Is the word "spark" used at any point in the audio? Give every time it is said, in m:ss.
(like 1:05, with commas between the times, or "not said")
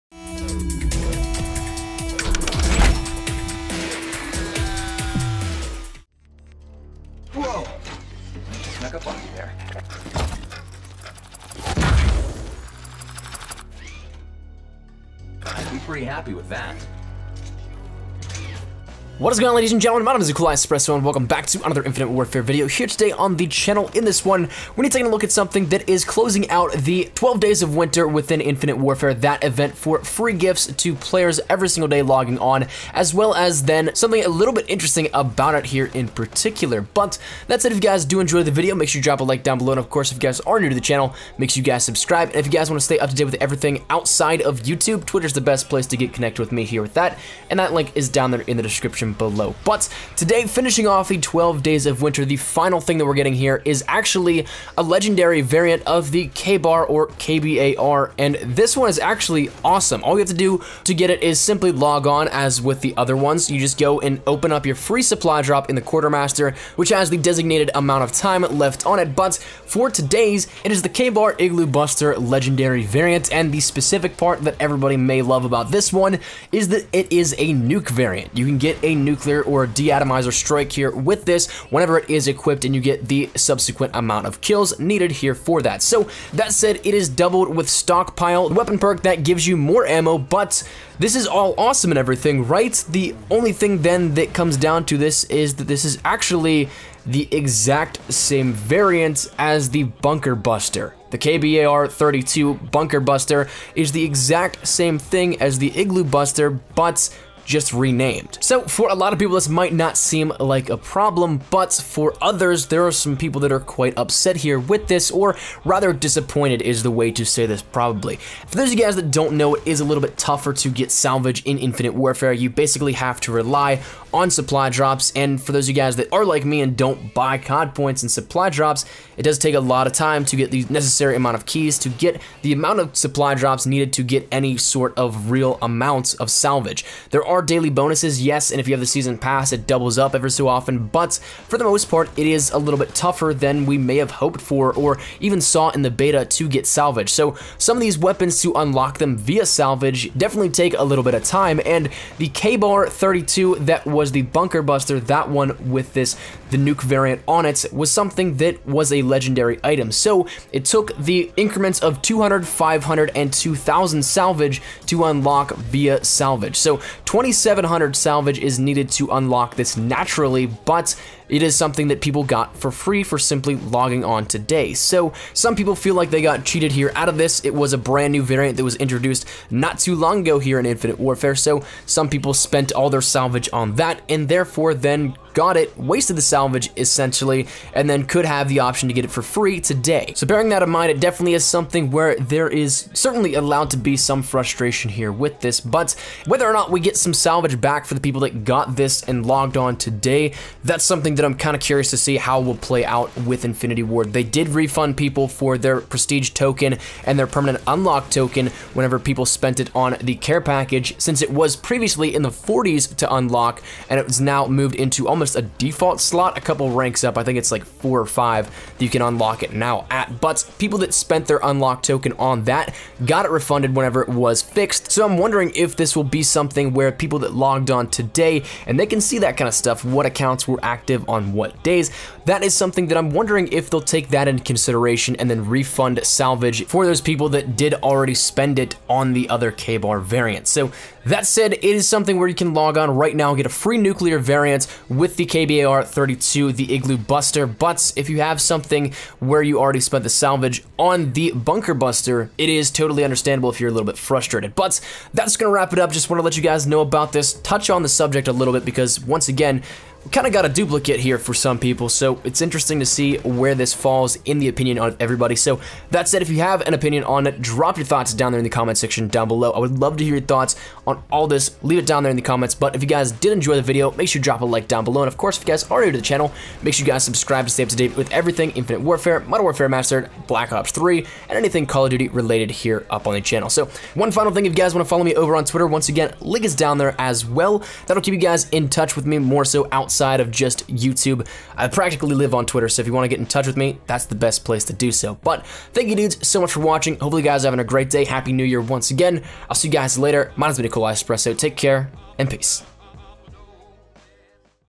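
not said.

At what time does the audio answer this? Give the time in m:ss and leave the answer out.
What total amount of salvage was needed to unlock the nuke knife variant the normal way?
2:47.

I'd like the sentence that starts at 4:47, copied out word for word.
That'll keep you guys in touch with me more so out outside of just YouTube.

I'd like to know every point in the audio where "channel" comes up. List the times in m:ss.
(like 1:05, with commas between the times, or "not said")
0:23, 0:40, 4:36, 4:43.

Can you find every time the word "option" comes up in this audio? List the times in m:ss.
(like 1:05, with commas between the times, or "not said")
3:08.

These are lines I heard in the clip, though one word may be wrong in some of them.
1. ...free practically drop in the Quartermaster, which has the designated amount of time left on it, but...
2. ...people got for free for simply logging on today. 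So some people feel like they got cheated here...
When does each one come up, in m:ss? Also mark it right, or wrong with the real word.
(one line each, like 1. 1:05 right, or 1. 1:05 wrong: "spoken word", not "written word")
1. 1:04 wrong: "supply", not "practically"
2. 2:52 right.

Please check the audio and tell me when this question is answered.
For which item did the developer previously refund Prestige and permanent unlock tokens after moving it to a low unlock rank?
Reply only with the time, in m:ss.
3:30.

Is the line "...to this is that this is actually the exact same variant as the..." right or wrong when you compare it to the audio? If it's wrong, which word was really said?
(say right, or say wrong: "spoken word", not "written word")
right.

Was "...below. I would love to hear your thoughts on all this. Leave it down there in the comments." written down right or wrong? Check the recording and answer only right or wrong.
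right.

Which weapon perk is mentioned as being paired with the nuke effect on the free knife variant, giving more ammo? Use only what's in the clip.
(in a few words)
stockpile.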